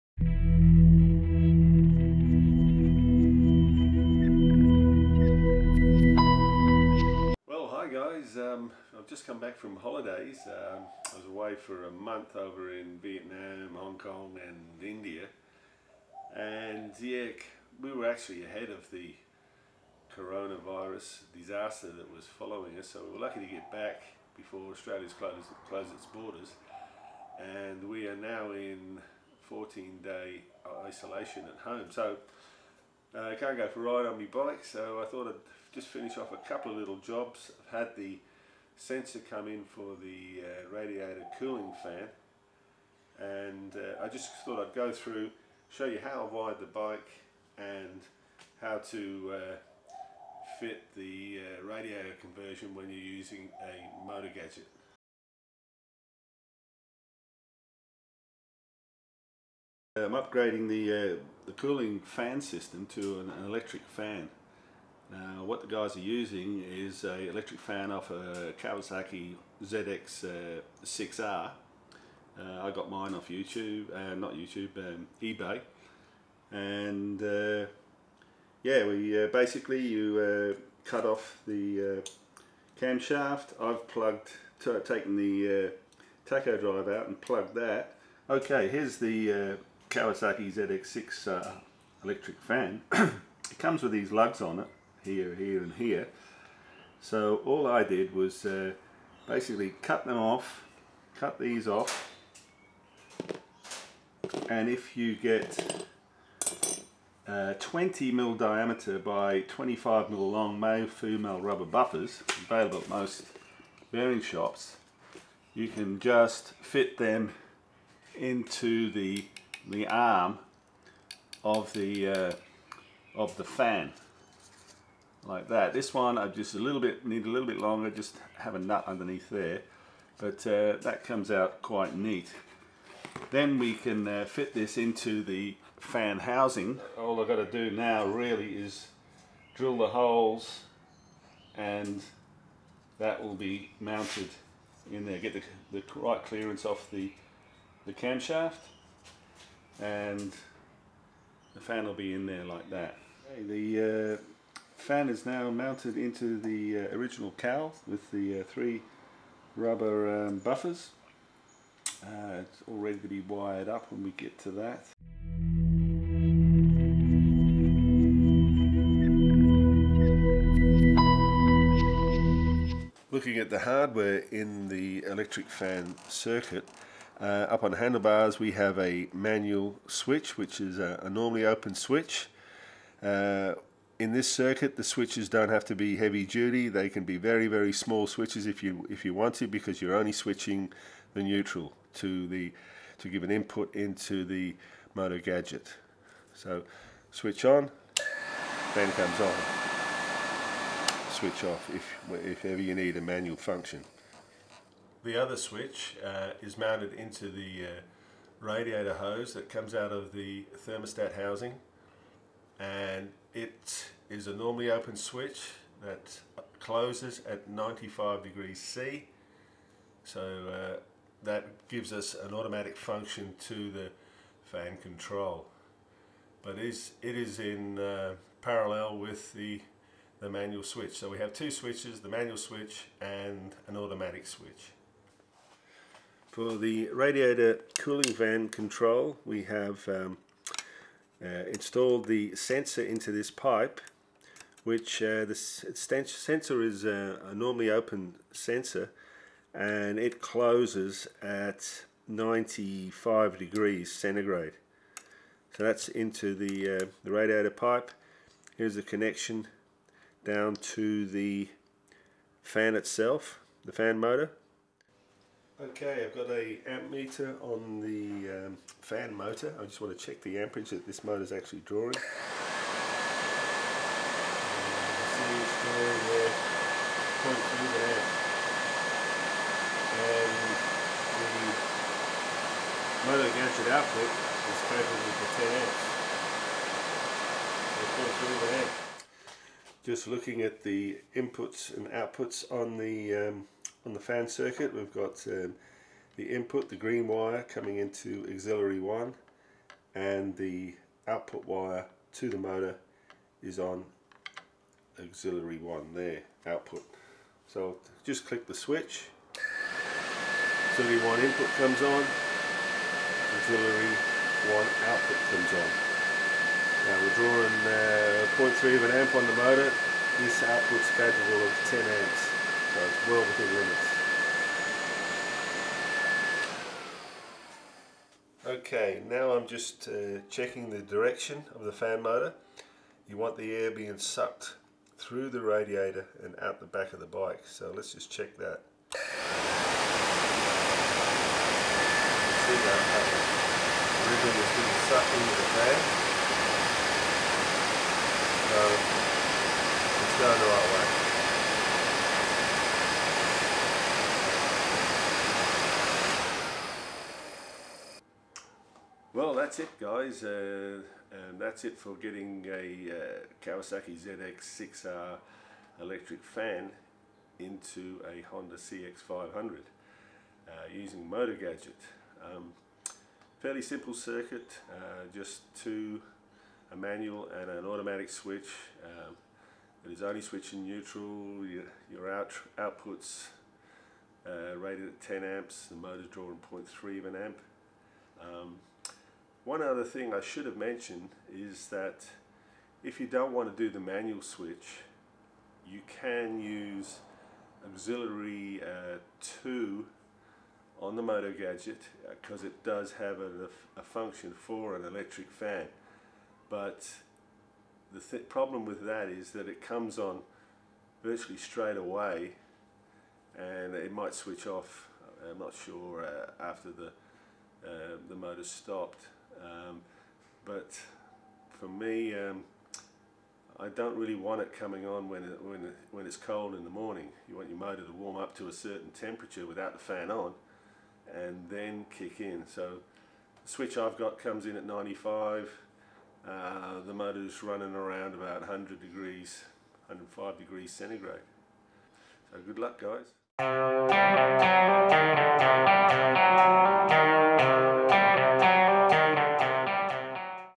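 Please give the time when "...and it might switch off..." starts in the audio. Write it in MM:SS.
06:53.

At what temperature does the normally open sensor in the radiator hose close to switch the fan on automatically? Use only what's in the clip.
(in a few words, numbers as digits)
95 degrees C.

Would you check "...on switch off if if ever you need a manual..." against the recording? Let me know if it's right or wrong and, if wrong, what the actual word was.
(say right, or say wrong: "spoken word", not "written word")
right.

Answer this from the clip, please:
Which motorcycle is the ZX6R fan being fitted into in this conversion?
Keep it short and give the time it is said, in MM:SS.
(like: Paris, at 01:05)
Honda CX500, at 06:08.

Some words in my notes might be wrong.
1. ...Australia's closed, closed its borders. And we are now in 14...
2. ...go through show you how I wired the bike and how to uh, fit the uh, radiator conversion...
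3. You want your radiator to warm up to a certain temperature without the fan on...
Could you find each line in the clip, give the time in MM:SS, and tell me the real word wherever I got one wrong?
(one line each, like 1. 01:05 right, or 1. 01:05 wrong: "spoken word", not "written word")
1. 00:24 right
2. 00:44 right
3. 07:07 wrong: "motor", not "radiator".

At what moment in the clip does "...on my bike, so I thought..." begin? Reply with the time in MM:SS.
00:34.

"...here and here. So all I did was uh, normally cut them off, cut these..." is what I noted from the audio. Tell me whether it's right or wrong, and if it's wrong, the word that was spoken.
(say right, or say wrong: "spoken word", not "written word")
wrong: "basically", not "normally".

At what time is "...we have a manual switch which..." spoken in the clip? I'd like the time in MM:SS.
02:58.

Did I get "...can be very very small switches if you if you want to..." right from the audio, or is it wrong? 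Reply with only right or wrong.
right.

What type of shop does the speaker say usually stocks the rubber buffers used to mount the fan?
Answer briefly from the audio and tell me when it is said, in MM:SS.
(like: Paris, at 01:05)
bearing shops, at 01:53.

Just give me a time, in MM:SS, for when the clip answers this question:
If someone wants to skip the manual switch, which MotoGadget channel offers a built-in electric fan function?
06:37.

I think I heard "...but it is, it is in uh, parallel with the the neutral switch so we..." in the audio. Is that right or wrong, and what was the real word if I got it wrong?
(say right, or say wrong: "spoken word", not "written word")
wrong: "manual", not "neutral".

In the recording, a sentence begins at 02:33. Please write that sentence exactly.
Okay, the uh, fan is now mounted into the uh, original cowl with the uh, three rubber um, buffers.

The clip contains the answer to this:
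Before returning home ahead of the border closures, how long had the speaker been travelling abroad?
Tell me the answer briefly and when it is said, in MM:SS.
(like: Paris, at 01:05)
a month, at 00:11.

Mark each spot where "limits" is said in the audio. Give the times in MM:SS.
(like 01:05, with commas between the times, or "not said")
05:23.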